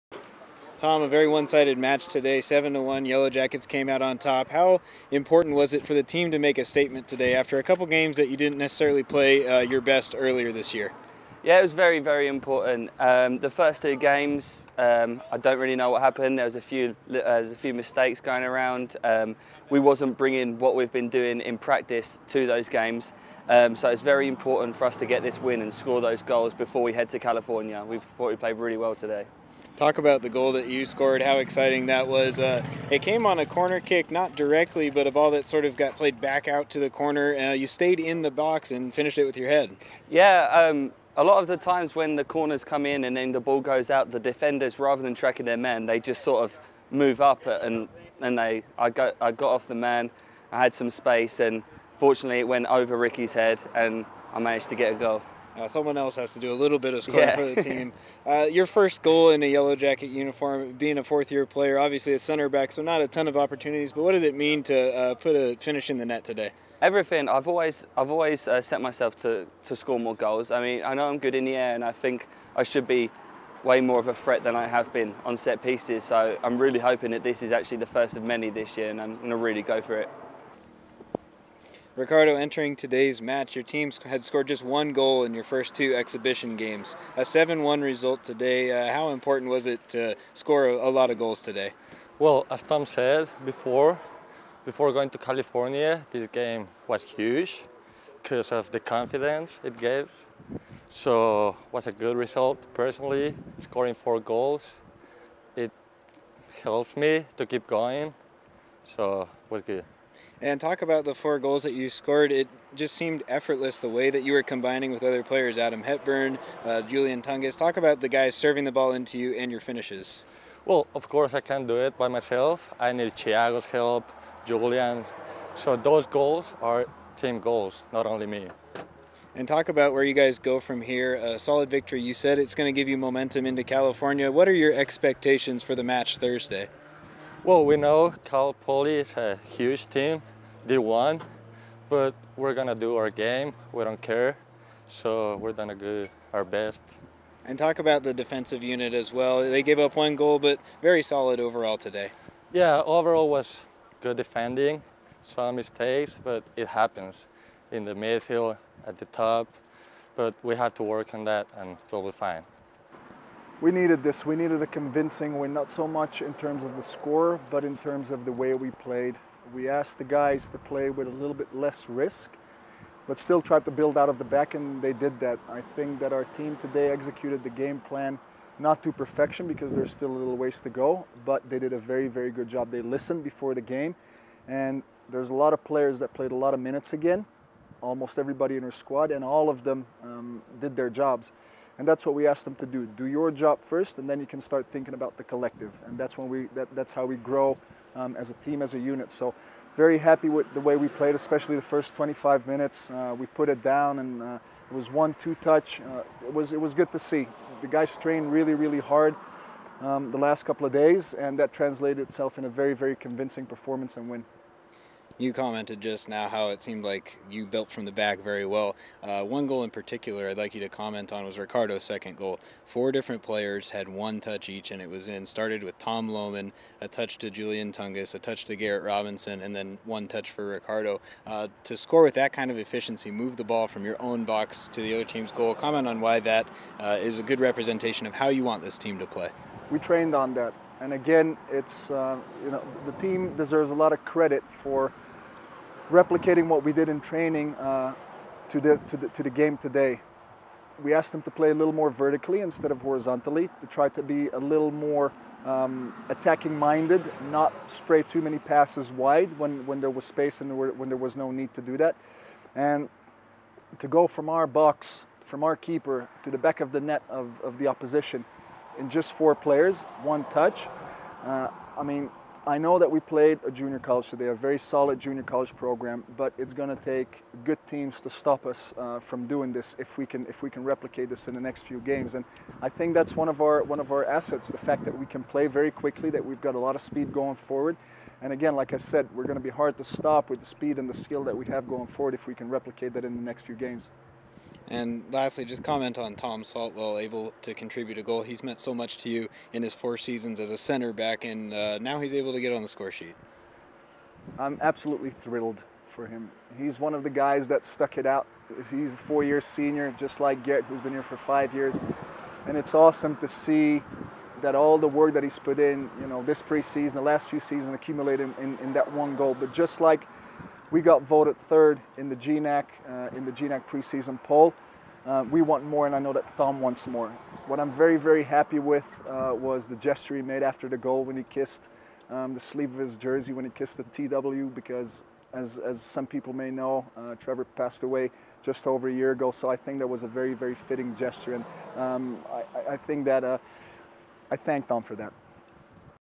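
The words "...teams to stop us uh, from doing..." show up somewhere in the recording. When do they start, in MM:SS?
04:37.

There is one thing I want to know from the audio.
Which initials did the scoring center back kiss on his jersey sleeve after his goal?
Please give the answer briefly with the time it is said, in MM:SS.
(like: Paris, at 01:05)
TW, at 05:33.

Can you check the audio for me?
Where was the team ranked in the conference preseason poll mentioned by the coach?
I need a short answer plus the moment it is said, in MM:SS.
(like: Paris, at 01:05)
Third, at 05:21.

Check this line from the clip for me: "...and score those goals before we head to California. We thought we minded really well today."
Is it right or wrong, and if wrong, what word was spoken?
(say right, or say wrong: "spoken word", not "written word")
wrong: "played", not "minded".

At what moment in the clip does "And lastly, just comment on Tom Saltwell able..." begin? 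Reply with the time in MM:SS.
04:54.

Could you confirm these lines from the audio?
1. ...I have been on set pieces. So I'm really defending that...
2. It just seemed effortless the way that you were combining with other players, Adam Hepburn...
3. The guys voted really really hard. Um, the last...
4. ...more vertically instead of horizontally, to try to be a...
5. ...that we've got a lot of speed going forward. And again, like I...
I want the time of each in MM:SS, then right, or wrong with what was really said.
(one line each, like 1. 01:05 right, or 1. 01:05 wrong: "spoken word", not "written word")
1. 01:14 wrong: "hoping", not "defending"
2. 01:52 right
3. 03:27 wrong: "trained", not "voted"
4. 04:11 right
5. 04:46 right.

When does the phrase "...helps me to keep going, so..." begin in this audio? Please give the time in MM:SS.
01:46.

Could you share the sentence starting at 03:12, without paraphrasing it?
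Do your job first, and then you can start thinking about the collective.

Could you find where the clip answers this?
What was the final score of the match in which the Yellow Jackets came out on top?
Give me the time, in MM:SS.
00:02.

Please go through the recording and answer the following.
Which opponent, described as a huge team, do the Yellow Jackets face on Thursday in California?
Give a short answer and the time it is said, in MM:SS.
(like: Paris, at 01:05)
Cal Poly, at 02:18.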